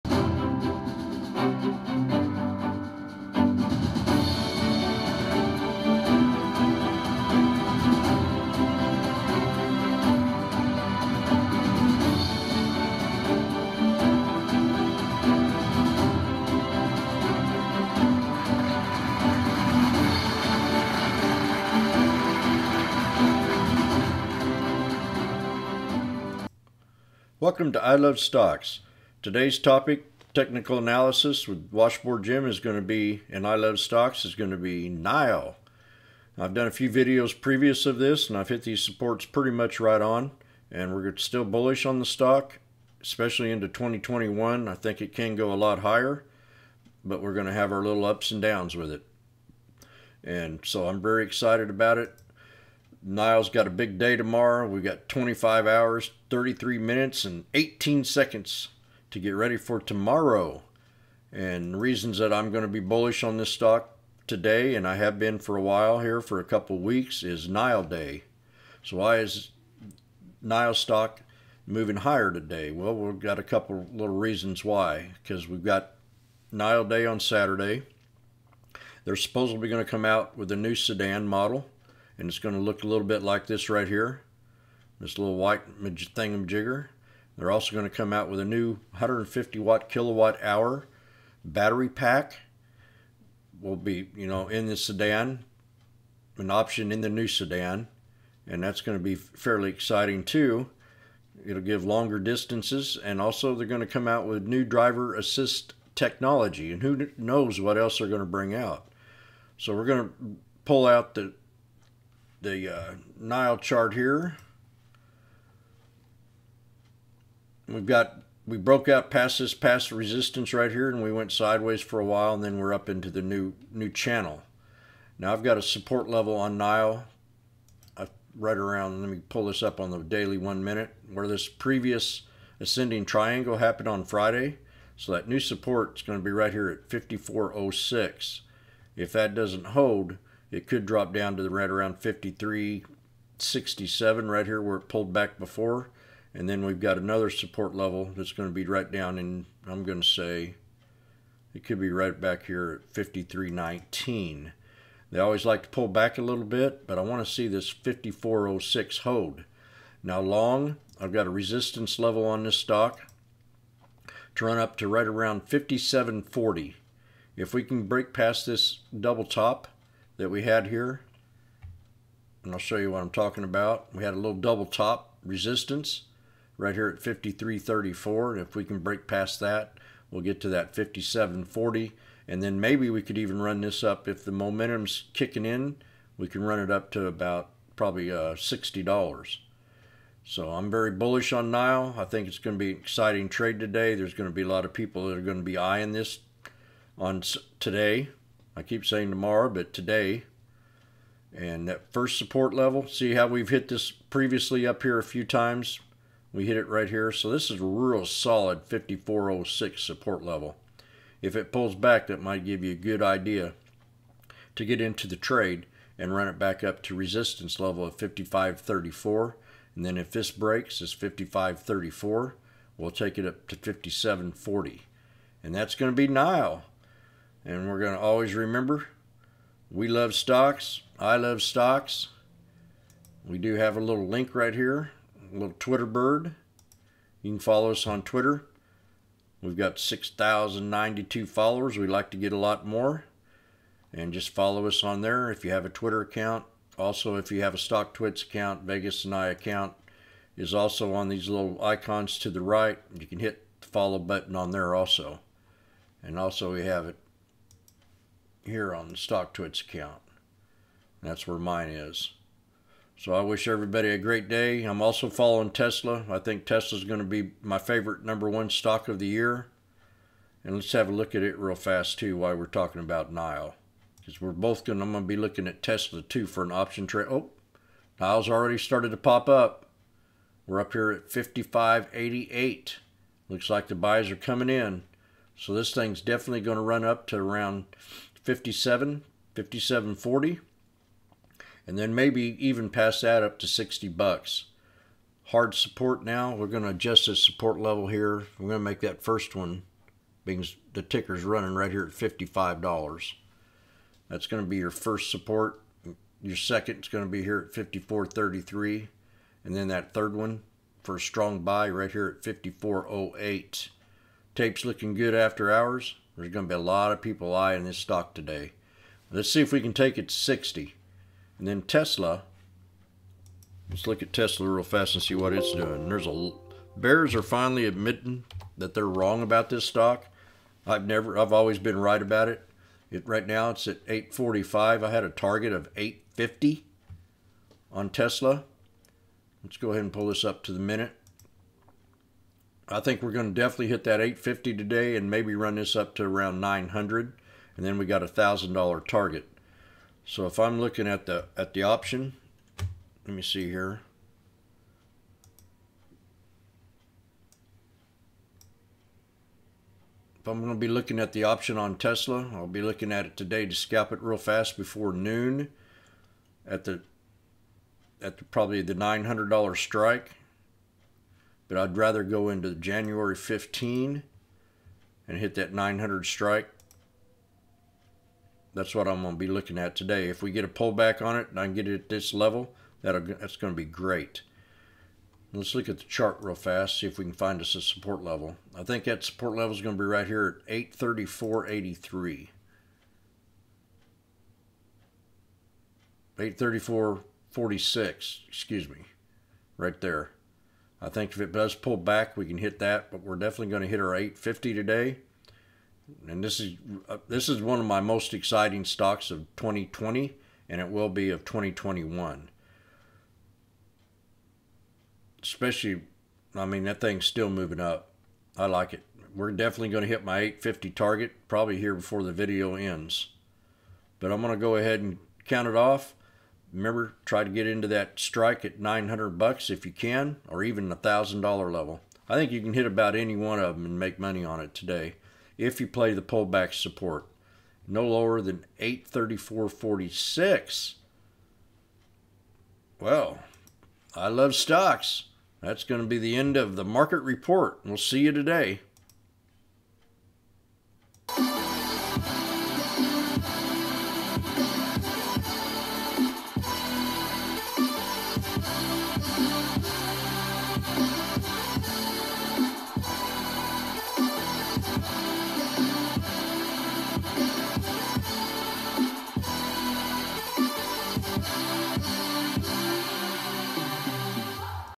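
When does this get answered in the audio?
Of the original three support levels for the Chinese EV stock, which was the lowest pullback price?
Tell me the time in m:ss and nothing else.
2:32.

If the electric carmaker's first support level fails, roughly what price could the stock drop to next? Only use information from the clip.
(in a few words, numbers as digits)
53.67.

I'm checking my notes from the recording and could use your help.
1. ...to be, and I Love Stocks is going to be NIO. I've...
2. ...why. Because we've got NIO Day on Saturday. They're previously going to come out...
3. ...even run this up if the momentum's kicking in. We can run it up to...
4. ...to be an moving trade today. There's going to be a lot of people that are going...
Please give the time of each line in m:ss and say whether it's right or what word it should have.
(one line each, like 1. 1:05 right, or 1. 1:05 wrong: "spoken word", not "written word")
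1. 0:32 right
2. 1:14 wrong: "supposedly", not "previously"
3. 3:03 right
4. 3:12 wrong: "exciting", not "moving".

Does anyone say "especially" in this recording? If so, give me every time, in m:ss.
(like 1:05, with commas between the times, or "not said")
0:43, 6:55.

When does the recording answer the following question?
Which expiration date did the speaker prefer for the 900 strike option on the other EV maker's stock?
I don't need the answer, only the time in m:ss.
6:12.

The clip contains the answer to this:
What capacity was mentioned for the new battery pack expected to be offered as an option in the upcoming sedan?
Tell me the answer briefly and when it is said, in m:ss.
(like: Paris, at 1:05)
150 kilowatt hour, at 1:28.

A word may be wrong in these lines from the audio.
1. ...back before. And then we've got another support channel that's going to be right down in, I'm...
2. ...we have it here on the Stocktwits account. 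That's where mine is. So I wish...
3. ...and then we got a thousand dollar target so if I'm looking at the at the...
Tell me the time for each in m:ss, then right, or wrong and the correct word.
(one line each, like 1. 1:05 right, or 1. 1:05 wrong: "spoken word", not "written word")
1. 2:25 wrong: "level", not "channel"
2. 4:16 right
3. 5:47 right.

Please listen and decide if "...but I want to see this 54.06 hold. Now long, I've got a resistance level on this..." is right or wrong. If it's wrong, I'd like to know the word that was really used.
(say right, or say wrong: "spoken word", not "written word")
right.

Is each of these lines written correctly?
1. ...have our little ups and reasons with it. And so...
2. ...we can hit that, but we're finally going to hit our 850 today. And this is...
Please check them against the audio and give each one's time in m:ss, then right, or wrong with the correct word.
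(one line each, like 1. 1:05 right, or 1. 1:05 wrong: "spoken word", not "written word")
1. 0:47 wrong: "downs", not "reasons"
2. 6:42 wrong: "definitely", not "finally".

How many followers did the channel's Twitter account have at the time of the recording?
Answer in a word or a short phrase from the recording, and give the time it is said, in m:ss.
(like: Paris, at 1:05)
6,092, at 3:59.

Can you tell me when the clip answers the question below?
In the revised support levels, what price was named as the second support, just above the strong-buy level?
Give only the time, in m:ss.
5:07.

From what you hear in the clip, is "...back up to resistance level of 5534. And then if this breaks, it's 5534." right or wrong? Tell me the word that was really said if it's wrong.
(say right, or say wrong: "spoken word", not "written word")
right.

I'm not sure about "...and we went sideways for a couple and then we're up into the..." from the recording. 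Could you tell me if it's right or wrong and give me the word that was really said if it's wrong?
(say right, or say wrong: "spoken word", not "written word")
wrong: "while", not "couple".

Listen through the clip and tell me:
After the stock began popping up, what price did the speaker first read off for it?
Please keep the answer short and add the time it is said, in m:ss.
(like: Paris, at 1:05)
55.88, at 4:41.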